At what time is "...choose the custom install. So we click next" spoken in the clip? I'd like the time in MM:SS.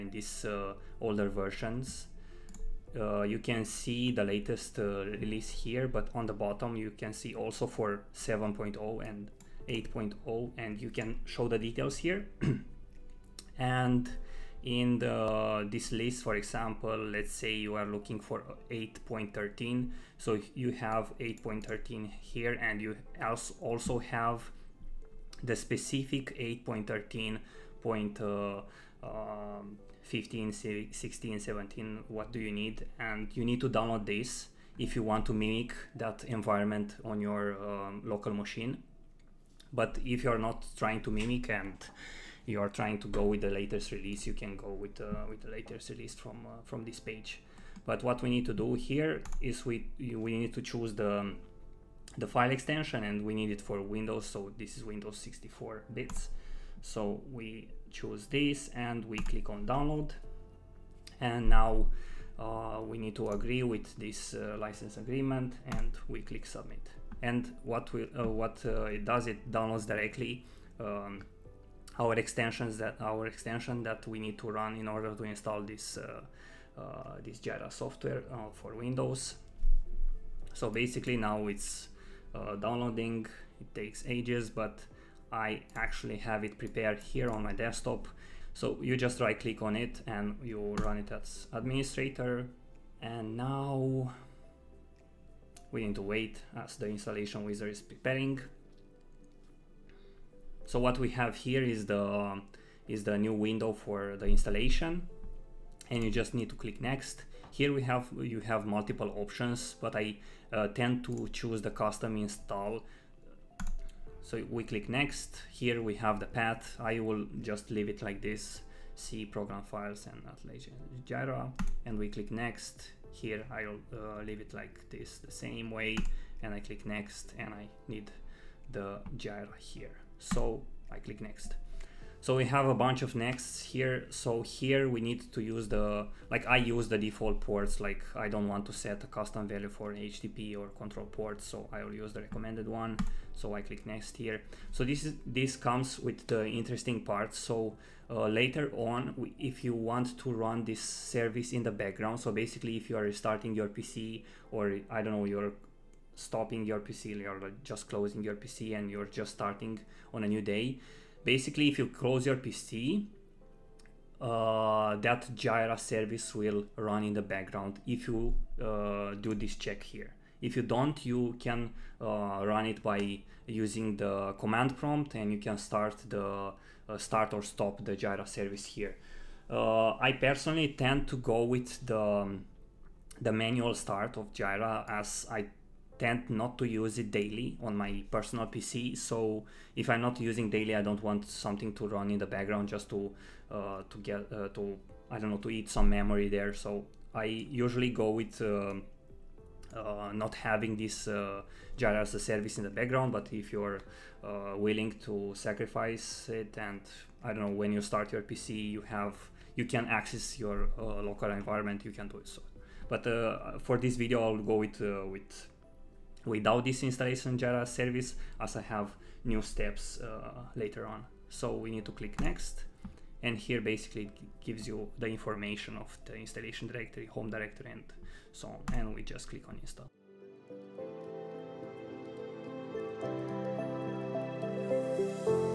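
01:51.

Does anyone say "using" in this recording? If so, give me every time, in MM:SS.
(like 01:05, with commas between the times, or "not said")
02:53, 03:10.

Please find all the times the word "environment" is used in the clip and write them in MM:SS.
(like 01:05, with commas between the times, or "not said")
00:36, 03:31.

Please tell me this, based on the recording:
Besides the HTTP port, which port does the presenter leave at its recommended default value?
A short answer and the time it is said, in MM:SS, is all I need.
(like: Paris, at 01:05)
Control port, at 02:20.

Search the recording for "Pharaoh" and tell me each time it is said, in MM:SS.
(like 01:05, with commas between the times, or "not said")
not said.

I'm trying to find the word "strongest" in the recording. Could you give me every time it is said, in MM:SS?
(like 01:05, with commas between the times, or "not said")
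not said.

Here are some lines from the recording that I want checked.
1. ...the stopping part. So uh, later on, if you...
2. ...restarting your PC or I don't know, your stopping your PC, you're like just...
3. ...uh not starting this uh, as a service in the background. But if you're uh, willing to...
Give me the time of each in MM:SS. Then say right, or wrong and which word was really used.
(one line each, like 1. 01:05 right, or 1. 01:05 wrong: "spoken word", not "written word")
1. 02:26 wrong: "interesting", not "stopping"
2. 02:33 right
3. 03:19 wrong: "having", not "starting".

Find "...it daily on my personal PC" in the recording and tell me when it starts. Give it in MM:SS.
03:06.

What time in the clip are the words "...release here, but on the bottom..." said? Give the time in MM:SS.
00:05.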